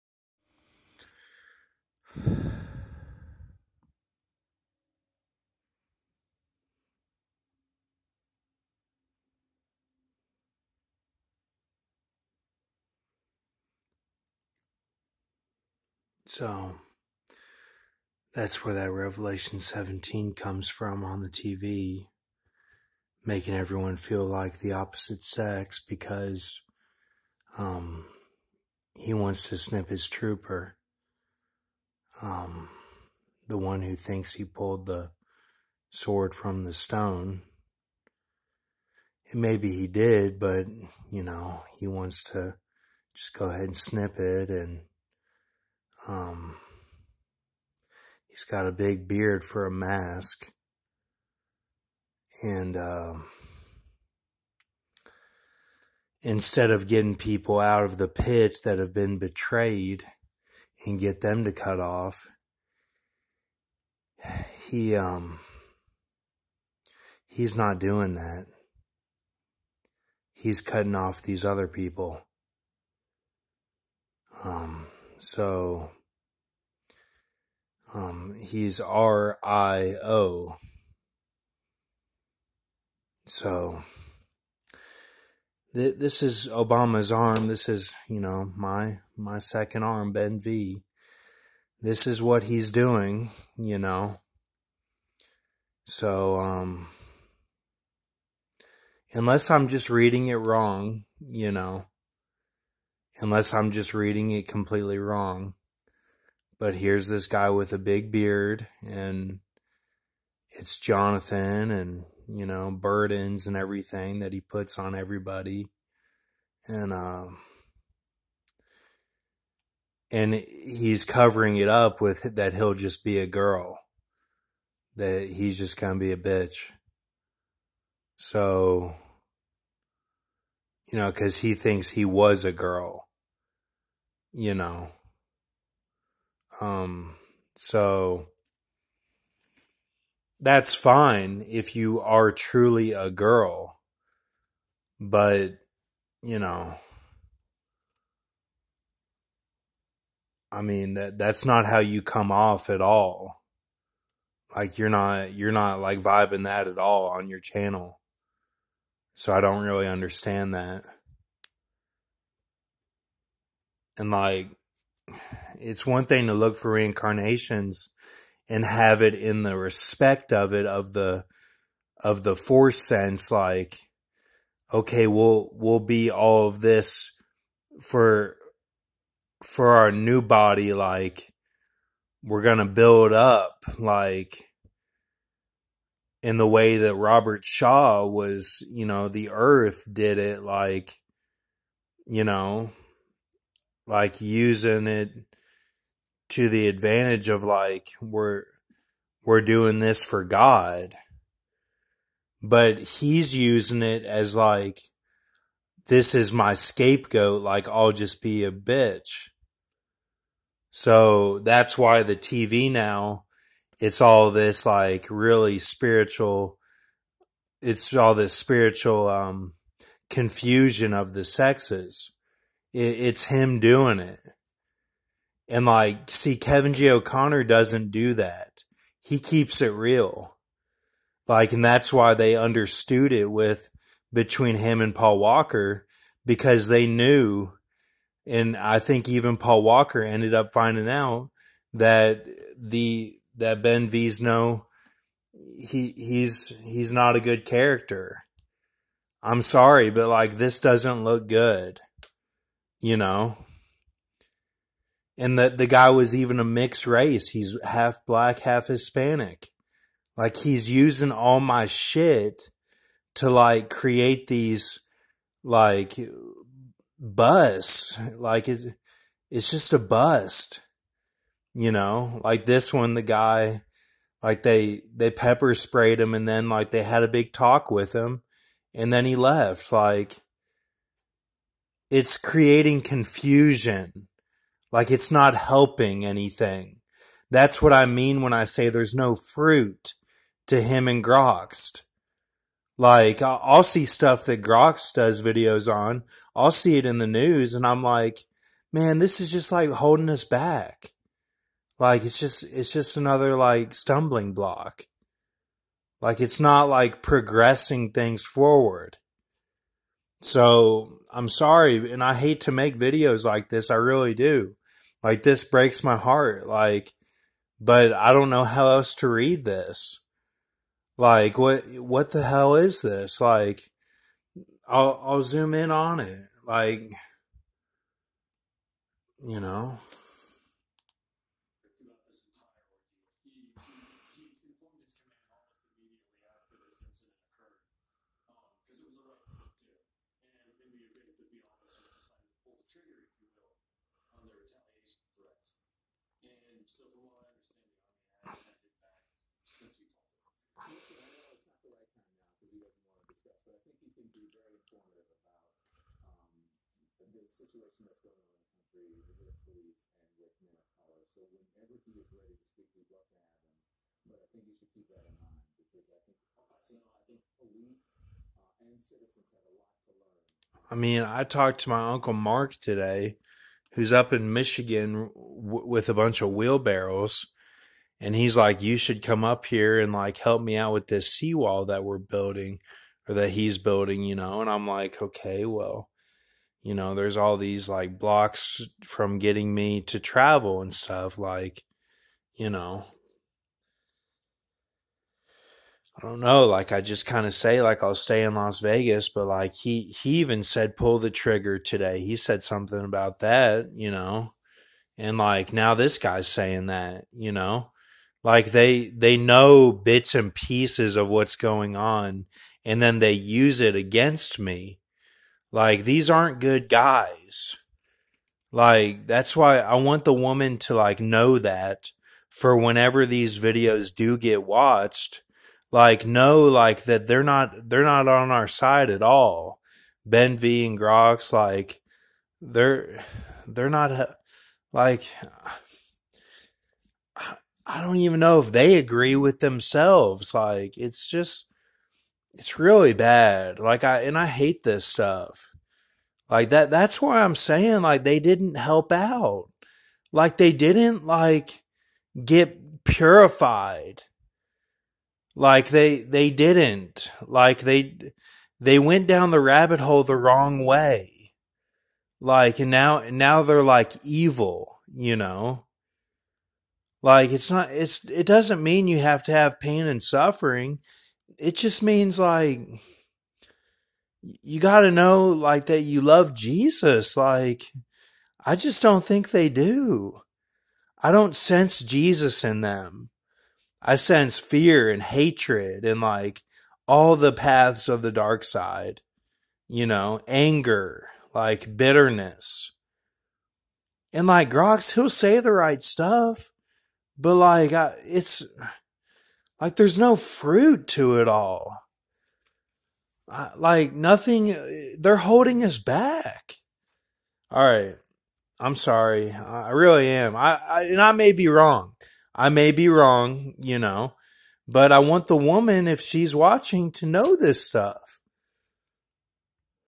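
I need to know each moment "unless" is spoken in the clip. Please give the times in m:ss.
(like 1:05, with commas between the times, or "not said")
1:39, 1:43.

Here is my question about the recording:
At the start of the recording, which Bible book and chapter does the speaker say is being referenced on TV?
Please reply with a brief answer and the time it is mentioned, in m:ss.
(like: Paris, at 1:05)
Revelation 17, at 0:18.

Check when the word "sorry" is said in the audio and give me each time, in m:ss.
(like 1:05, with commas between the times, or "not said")
4:09, 5:11, 8:28.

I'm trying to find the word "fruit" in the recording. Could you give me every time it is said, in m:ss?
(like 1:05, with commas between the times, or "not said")
4:49, 8:20.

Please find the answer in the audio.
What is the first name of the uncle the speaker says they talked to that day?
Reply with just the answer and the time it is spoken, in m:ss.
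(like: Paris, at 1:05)
Mark, at 6:12.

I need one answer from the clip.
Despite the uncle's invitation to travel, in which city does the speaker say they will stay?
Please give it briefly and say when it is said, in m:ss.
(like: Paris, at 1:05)
Las Vegas, at 6:38.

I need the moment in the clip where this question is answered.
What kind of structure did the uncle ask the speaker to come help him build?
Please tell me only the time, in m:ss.
6:21.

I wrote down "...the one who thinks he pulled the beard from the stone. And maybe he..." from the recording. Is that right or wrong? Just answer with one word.
wrong.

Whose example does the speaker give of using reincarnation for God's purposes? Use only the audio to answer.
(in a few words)
Robert Shaw.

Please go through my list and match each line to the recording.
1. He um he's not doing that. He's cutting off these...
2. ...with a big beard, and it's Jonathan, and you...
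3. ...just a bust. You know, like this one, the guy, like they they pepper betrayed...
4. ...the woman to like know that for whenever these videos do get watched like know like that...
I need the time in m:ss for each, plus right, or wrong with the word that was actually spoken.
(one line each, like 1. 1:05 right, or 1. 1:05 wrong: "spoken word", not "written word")
1. 1:04 right
2. 1:47 right
3. 4:29 wrong: "sprayed", not "betrayed"
4. 7:00 right.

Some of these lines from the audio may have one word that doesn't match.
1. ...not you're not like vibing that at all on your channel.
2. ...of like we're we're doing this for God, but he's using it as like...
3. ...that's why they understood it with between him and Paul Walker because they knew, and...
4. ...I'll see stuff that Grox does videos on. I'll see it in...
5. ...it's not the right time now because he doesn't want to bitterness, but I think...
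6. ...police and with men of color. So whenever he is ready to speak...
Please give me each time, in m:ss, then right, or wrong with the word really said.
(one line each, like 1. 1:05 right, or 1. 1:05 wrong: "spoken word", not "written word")
1. 2:34 right
2. 3:17 right
3. 3:51 right
4. 4:53 right
5. 5:51 wrong: "discuss", not "bitterness"
6. 5:59 right.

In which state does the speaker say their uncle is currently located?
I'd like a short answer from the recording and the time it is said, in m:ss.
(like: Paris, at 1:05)
Michigan, at 6:14.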